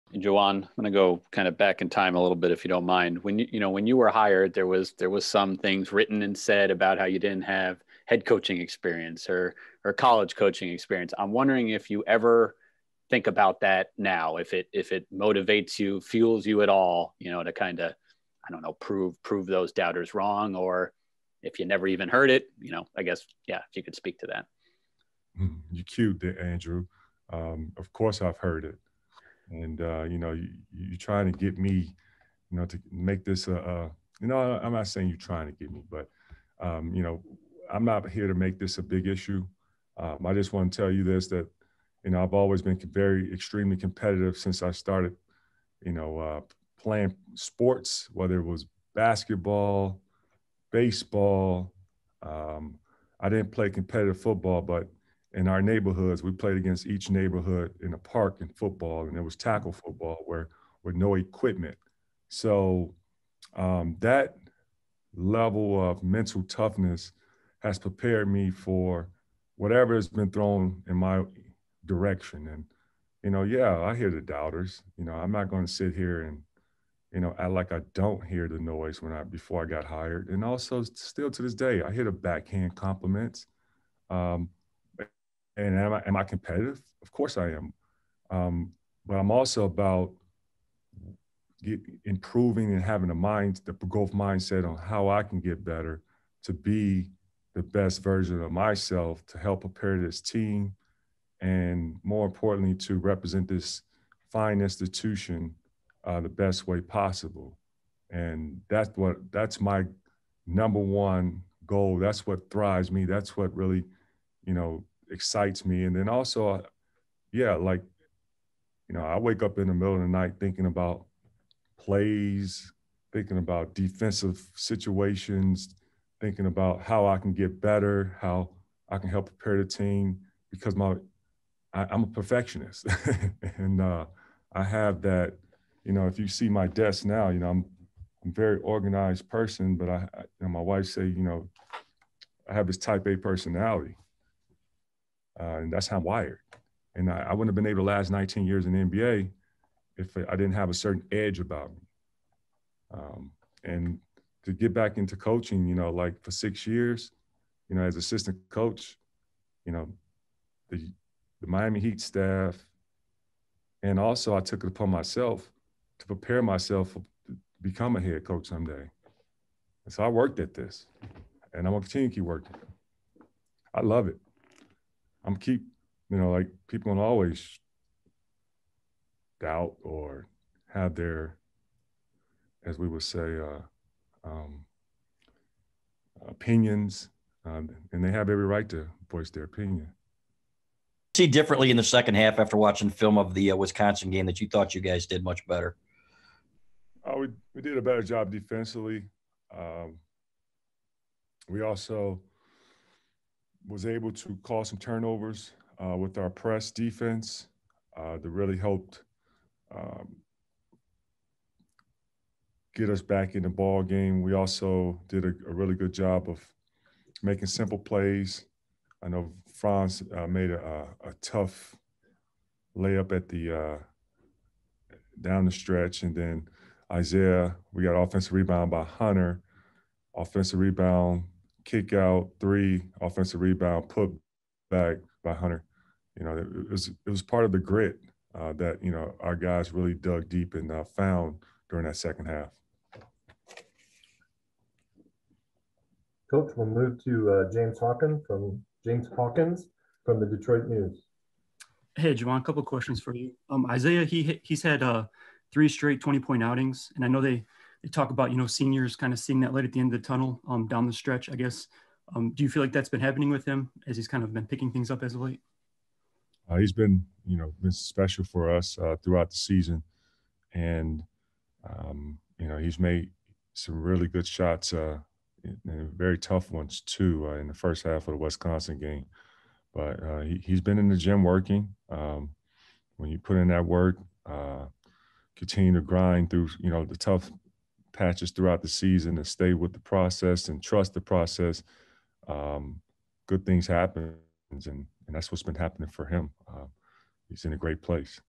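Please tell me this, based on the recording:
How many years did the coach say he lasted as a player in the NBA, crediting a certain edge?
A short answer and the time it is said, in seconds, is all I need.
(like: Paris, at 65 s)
19, at 148 s.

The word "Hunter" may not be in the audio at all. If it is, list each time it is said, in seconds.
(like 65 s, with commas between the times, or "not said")
228 s, 235 s.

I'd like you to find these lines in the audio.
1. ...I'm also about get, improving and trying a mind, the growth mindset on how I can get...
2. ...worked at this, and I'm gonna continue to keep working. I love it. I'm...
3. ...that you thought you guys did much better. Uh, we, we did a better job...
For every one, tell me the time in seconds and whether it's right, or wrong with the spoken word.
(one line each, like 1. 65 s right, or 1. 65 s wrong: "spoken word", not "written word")
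1. 89 s wrong: "having", not "trying"
2. 170 s right
3. 194 s right.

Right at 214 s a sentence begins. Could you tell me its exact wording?
We also did a, a really good job of making simple plays.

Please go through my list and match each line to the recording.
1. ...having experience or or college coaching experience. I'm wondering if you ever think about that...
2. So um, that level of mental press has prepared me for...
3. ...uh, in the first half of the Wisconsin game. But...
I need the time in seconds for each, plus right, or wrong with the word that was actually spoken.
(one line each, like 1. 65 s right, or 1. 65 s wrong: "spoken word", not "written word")
1. 8 s wrong: "coaching", not "having"
2. 62 s wrong: "toughness", not "press"
3. 277 s right.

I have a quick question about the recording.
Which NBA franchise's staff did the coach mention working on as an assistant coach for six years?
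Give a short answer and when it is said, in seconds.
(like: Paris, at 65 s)
Miami Heat, at 161 s.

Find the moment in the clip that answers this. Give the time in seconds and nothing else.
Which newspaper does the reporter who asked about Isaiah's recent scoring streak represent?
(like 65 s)
250 s.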